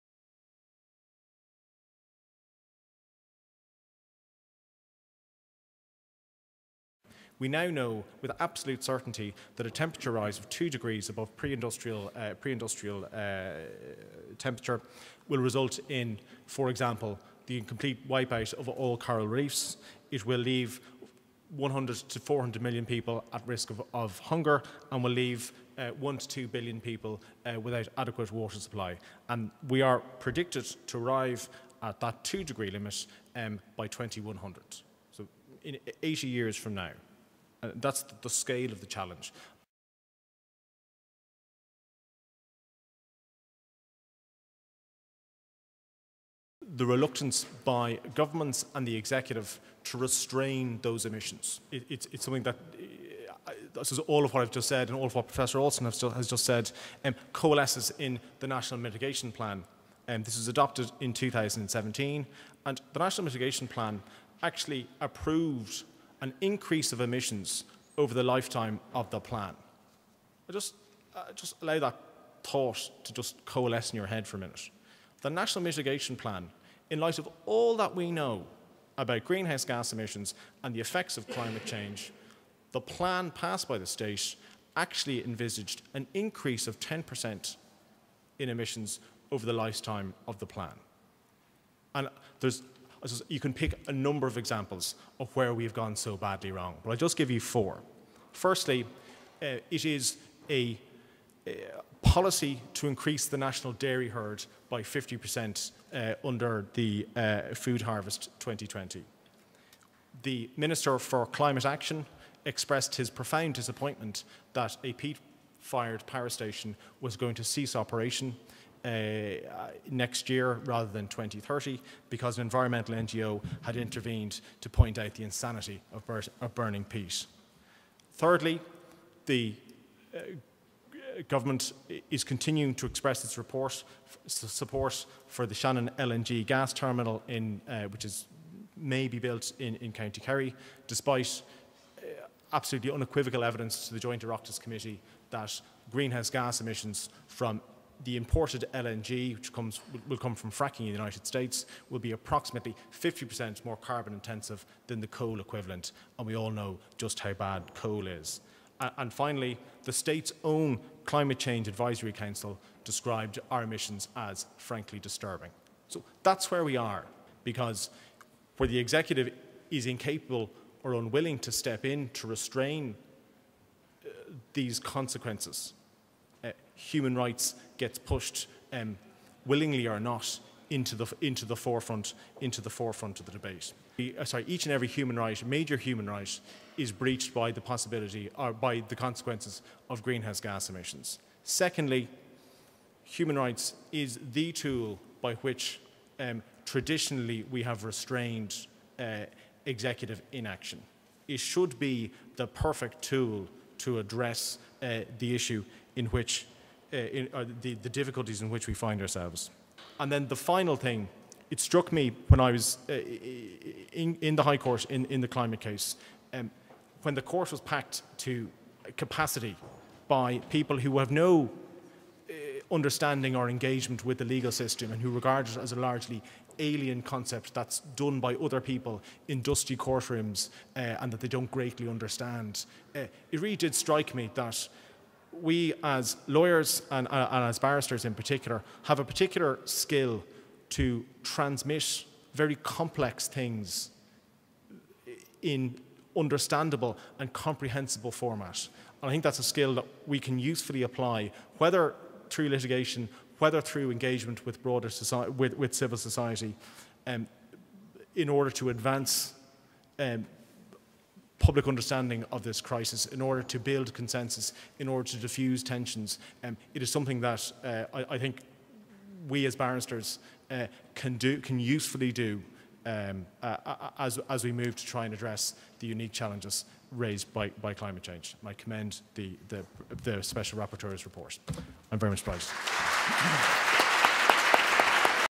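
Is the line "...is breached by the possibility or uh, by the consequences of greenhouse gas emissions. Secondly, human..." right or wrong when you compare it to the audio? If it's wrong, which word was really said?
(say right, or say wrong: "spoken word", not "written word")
right.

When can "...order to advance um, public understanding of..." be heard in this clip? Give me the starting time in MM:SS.
04:18.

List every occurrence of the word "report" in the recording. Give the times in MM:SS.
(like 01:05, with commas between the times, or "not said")
02:13, 04:41.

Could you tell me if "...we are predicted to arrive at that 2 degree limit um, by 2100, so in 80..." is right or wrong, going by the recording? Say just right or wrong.
right.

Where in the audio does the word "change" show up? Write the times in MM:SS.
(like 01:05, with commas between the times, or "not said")
01:21, 02:41, 04:38.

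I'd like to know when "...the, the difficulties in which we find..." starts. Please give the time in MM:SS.
03:27.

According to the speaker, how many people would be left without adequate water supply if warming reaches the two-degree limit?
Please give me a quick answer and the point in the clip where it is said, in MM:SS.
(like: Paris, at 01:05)
1 to 2 billion, at 00:25.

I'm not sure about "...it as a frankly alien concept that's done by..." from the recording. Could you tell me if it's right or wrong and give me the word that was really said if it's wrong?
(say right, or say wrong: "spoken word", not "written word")
wrong: "largely", not "frankly".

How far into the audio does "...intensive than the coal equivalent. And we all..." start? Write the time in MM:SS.
02:34.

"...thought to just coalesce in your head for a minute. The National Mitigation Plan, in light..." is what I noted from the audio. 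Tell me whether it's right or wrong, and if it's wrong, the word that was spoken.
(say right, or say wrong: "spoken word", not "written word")
right.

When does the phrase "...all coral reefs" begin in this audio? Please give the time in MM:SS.
00:18.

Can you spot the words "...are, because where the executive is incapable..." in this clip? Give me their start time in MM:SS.
02:46.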